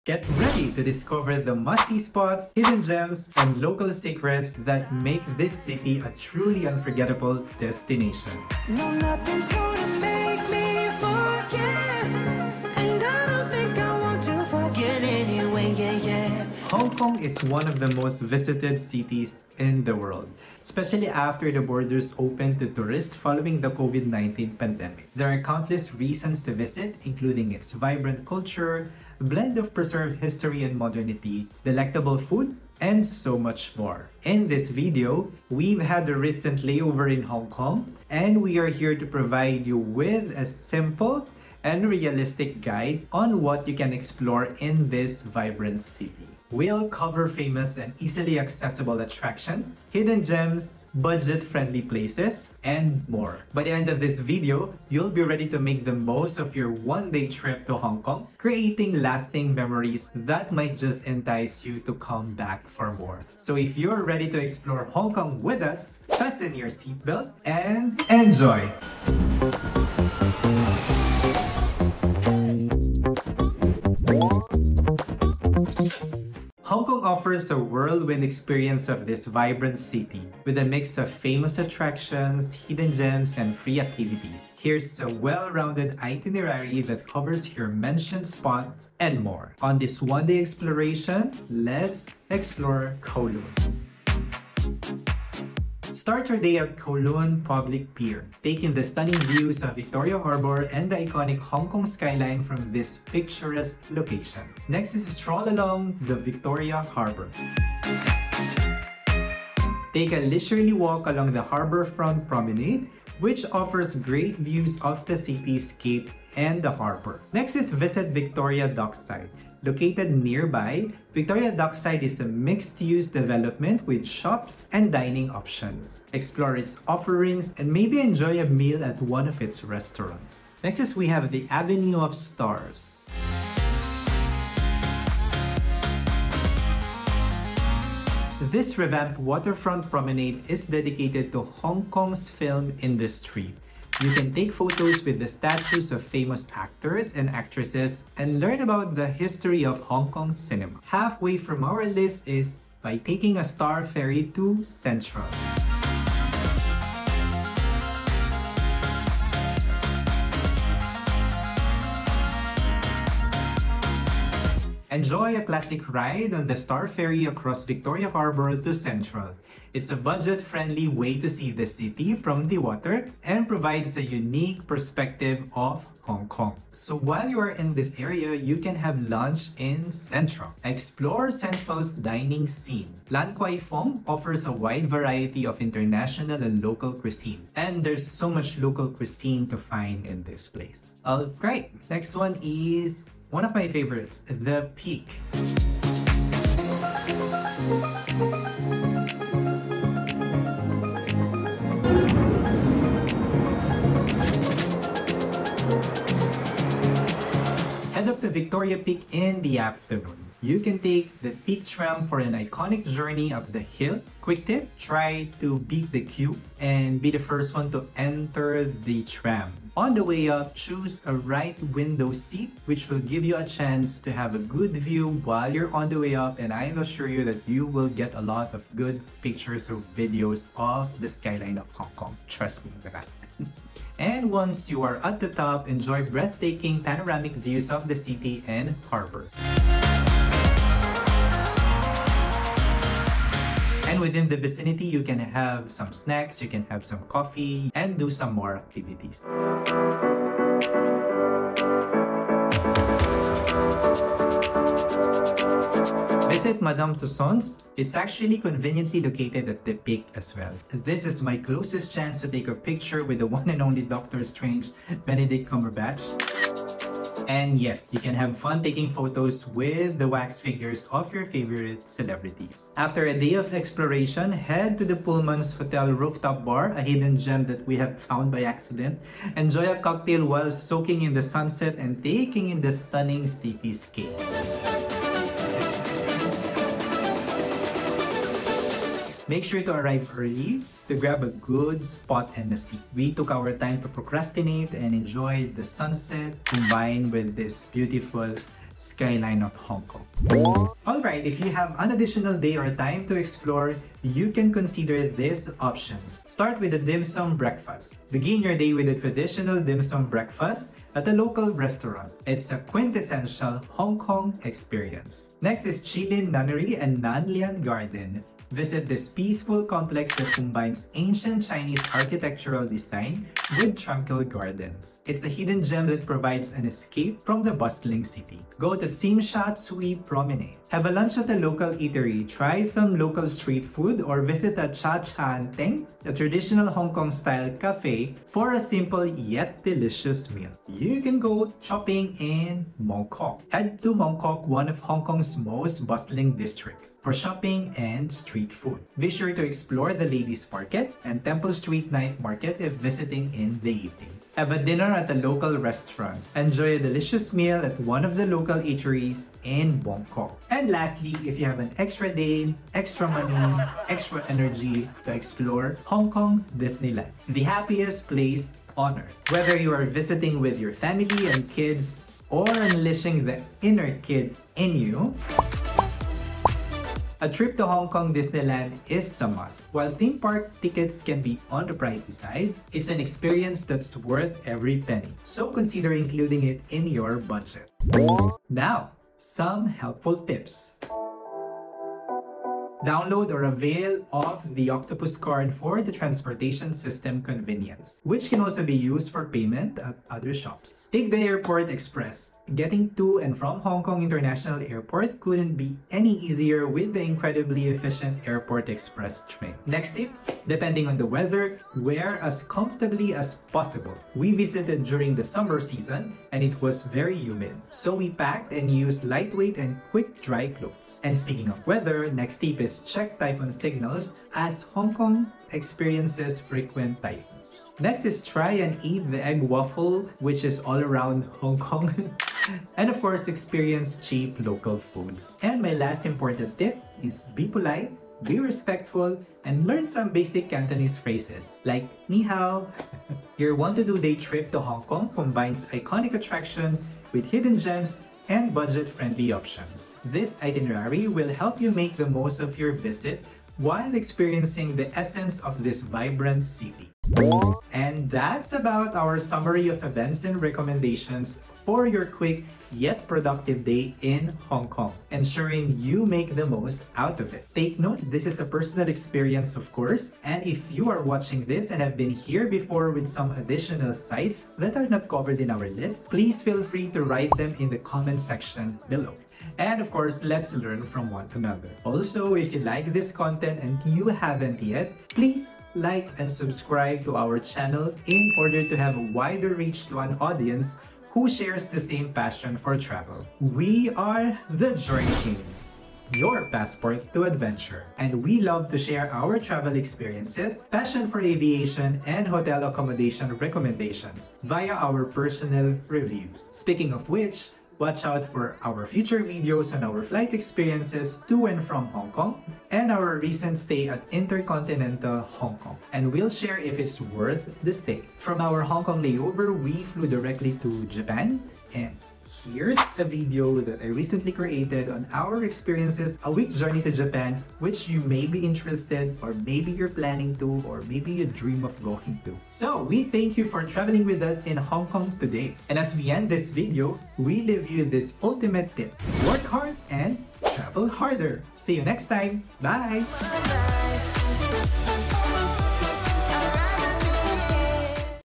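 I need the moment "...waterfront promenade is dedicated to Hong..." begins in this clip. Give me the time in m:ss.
2:19.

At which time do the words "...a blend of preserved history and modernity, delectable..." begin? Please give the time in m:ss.
0:29.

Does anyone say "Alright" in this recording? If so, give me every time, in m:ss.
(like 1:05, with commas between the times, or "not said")
3:11, 5:00.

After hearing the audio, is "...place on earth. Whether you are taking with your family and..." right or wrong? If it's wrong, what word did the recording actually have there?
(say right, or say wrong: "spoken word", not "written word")
wrong: "visiting", not "taking".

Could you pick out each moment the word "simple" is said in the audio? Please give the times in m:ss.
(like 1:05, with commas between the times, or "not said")
0:40, 5:38.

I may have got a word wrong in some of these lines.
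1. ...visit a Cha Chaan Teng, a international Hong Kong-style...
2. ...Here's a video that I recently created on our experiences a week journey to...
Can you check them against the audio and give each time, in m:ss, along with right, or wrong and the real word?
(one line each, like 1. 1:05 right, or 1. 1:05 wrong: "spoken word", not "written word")
1. 5:34 wrong: "traditional", not "international"
2. 8:42 right.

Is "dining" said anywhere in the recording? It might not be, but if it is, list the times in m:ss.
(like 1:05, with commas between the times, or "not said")
2:04, 3:01.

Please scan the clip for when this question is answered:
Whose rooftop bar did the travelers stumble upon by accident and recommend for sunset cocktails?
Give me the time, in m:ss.
4:34.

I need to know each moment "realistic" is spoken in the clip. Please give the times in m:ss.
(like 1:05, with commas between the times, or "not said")
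0:41.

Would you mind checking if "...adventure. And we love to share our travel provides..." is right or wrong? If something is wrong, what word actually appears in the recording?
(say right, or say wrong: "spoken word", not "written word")
wrong: "experiences", not "provides".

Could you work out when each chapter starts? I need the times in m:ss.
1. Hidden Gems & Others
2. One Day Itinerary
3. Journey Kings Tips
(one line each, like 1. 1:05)
1. 5:04
2. 1:34
3. 6:30.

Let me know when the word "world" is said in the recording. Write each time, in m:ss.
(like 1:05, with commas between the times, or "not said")
0:19.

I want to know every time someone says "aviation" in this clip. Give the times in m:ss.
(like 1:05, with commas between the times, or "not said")
8:21.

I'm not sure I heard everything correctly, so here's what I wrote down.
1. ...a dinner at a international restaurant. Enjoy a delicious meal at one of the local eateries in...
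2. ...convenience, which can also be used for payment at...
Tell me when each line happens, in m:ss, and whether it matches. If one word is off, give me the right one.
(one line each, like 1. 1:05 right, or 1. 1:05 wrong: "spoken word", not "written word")
1. 5:54 wrong: "local", not "international"
2. 6:37 right.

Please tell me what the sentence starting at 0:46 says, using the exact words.
We'll cover famous and easily accessible attractions, hidden gems, budget-friendly places, and more.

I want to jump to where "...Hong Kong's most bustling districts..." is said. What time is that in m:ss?
5:44.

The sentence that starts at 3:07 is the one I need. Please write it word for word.
And there's so much local cuisine to find in this place.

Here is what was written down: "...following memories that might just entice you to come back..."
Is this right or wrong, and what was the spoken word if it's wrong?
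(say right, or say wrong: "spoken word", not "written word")
wrong: "lasting", not "following".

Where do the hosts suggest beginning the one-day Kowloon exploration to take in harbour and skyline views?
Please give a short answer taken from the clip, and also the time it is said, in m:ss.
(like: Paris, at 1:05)
Kowloon Public Pier, at 1:36.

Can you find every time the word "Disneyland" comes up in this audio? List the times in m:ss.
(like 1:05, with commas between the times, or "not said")
6:06, 6:18.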